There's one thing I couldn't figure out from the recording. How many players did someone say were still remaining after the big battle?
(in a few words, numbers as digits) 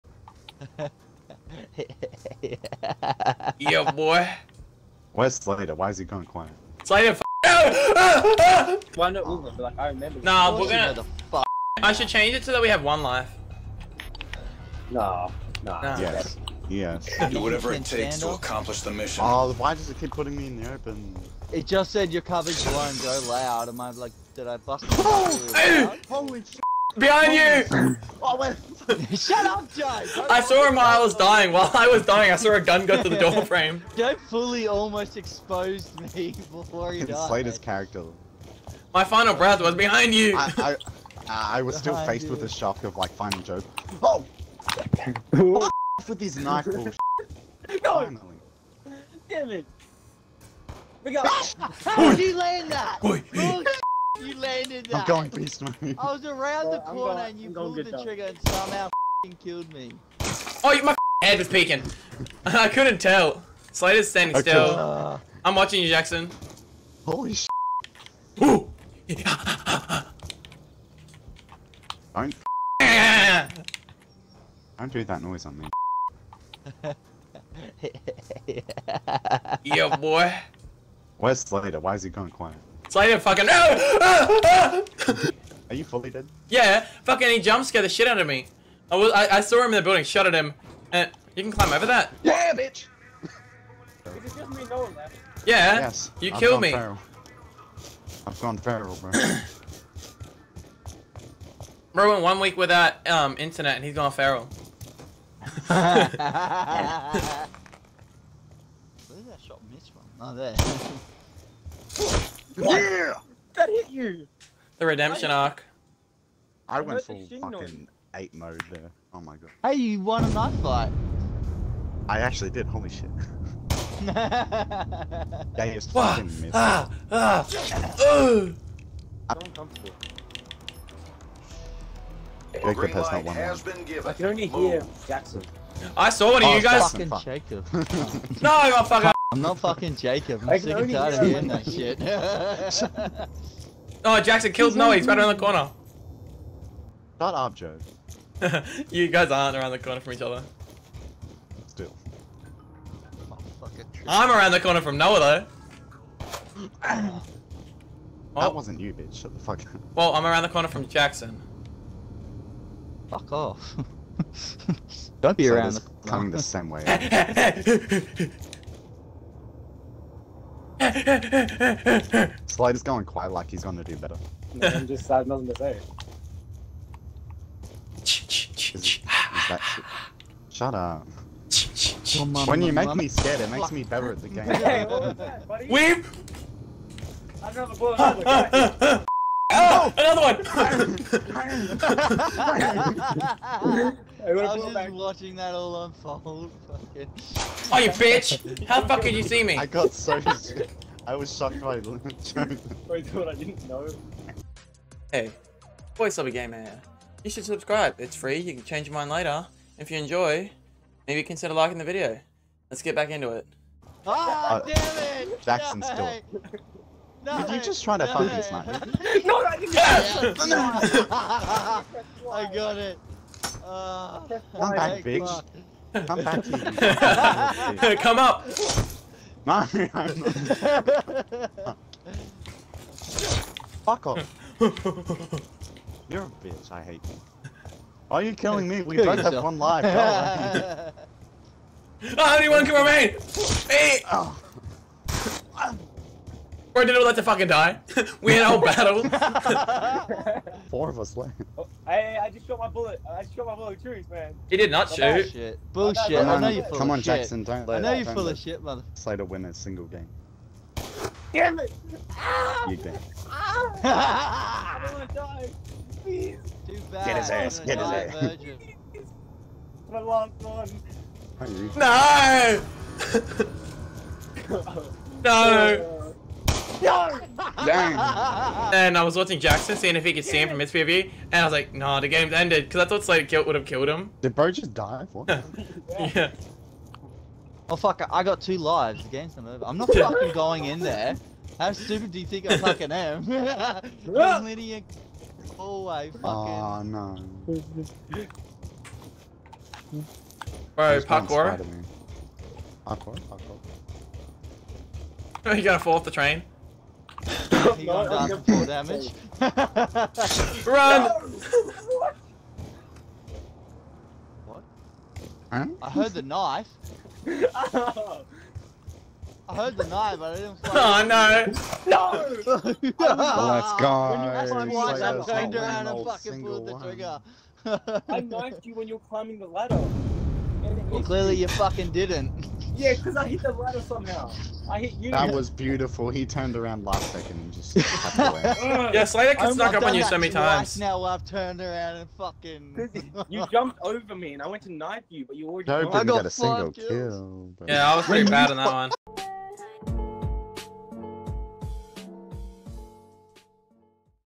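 4.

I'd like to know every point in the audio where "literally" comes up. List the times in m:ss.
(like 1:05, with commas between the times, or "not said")
4:54.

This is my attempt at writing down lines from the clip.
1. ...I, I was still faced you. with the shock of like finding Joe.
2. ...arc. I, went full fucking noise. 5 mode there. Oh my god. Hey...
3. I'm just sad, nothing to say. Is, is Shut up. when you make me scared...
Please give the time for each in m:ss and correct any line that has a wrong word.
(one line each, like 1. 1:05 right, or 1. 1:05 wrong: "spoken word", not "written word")
1. 0:41 right
2. 1:55 wrong: "8", not "5"
3. 2:54 right.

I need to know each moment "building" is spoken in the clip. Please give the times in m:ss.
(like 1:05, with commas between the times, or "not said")
1:29.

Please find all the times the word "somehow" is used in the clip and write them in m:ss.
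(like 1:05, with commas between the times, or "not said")
0:58, 5:33.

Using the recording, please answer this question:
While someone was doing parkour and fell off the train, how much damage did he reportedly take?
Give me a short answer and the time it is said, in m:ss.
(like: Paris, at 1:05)
4, at 5:08.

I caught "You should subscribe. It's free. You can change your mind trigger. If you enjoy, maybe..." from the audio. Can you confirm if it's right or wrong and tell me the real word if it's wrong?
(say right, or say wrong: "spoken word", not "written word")
wrong: "later", not "trigger".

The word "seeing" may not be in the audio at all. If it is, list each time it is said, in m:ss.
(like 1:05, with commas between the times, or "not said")
4:39.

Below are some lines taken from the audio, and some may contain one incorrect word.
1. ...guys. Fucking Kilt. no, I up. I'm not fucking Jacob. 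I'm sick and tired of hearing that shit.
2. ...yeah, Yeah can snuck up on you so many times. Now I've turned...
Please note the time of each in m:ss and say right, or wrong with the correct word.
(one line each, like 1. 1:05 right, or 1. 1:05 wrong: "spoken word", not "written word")
1. 2:16 wrong: "Jacob", not "Kilt"
2. 5:37 wrong: "Slater", not "Yeah".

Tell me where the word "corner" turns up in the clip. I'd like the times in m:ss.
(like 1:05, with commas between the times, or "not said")
0:56, 2:25, 2:29, 2:34, 2:40, 2:45.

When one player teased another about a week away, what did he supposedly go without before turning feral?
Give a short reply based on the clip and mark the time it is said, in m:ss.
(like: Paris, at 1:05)
internet, at 1:43.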